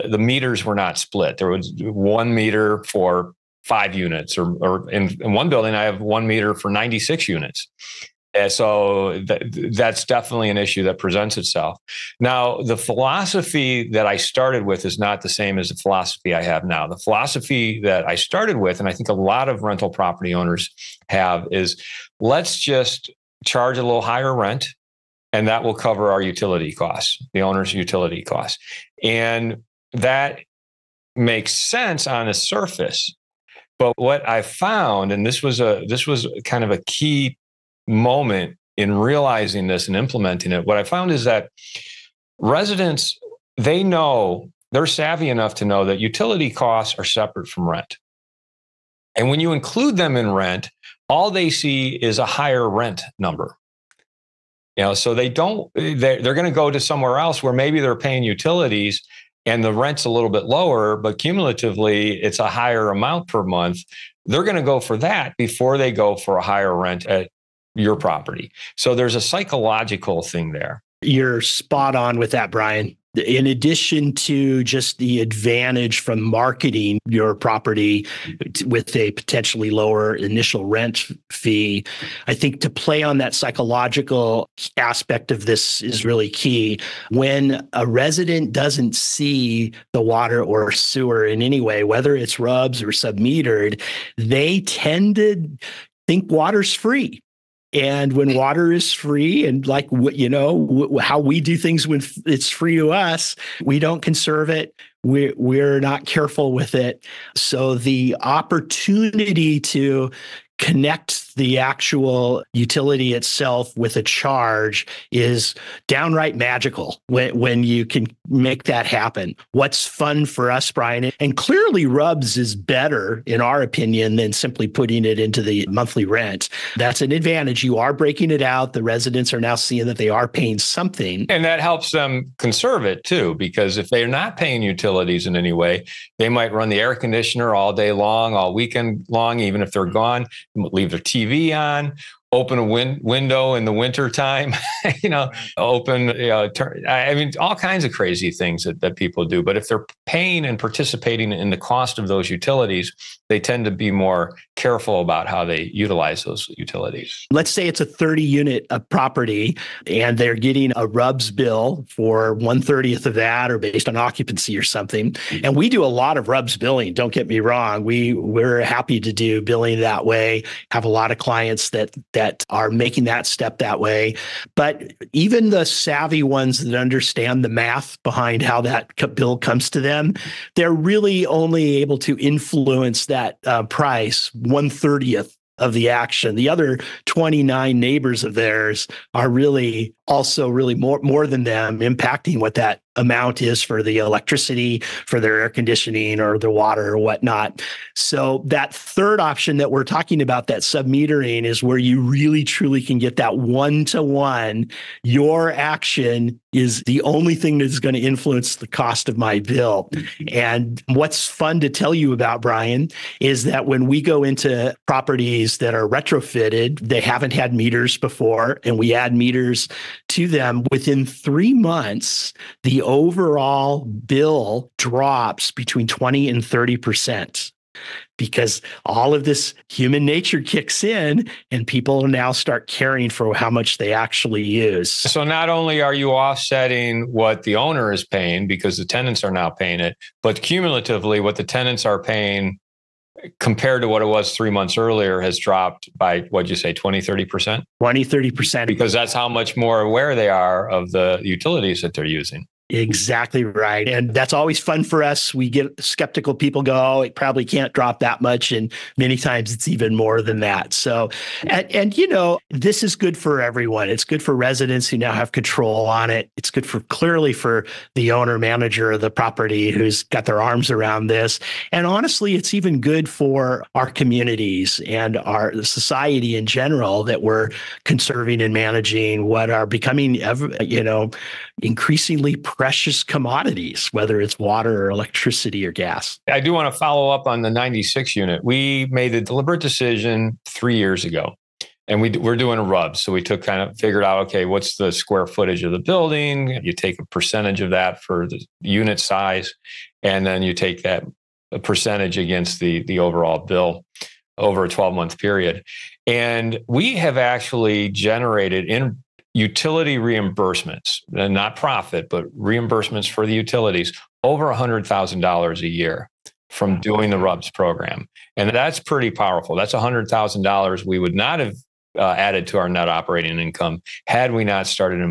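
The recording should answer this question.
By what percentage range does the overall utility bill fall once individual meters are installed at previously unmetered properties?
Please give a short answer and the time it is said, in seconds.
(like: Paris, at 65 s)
20 to 30%, at 225 s.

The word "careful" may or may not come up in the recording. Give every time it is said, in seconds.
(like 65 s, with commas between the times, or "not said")
106 s, 154 s.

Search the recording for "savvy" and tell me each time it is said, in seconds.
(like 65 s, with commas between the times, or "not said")
44 s, 175 s.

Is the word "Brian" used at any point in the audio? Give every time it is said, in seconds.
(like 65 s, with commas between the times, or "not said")
72 s, 120 s, 212 s.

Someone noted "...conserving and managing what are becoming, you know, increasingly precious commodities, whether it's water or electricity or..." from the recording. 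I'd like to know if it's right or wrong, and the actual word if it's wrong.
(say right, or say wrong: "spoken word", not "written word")
right.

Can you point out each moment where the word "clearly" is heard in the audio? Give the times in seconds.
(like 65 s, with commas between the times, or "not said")
121 s, 266 s.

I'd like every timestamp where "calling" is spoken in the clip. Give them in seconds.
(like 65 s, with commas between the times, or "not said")
not said.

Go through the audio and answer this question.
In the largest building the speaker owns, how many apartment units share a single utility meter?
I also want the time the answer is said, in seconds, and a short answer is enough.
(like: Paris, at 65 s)
96, at 6 s.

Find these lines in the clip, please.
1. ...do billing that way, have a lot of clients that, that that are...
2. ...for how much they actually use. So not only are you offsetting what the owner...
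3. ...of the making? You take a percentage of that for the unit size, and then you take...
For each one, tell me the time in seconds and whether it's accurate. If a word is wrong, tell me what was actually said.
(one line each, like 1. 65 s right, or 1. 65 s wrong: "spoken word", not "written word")
1. 169 s right
2. 233 s right
3. 295 s wrong: "building", not "making".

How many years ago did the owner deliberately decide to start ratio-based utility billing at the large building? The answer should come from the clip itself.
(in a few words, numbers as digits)
3 years.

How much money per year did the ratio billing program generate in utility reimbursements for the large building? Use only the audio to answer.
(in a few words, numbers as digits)
over $100,000.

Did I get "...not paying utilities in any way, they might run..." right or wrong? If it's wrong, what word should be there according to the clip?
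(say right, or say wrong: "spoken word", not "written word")
right.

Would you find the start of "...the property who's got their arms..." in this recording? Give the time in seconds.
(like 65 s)
269 s.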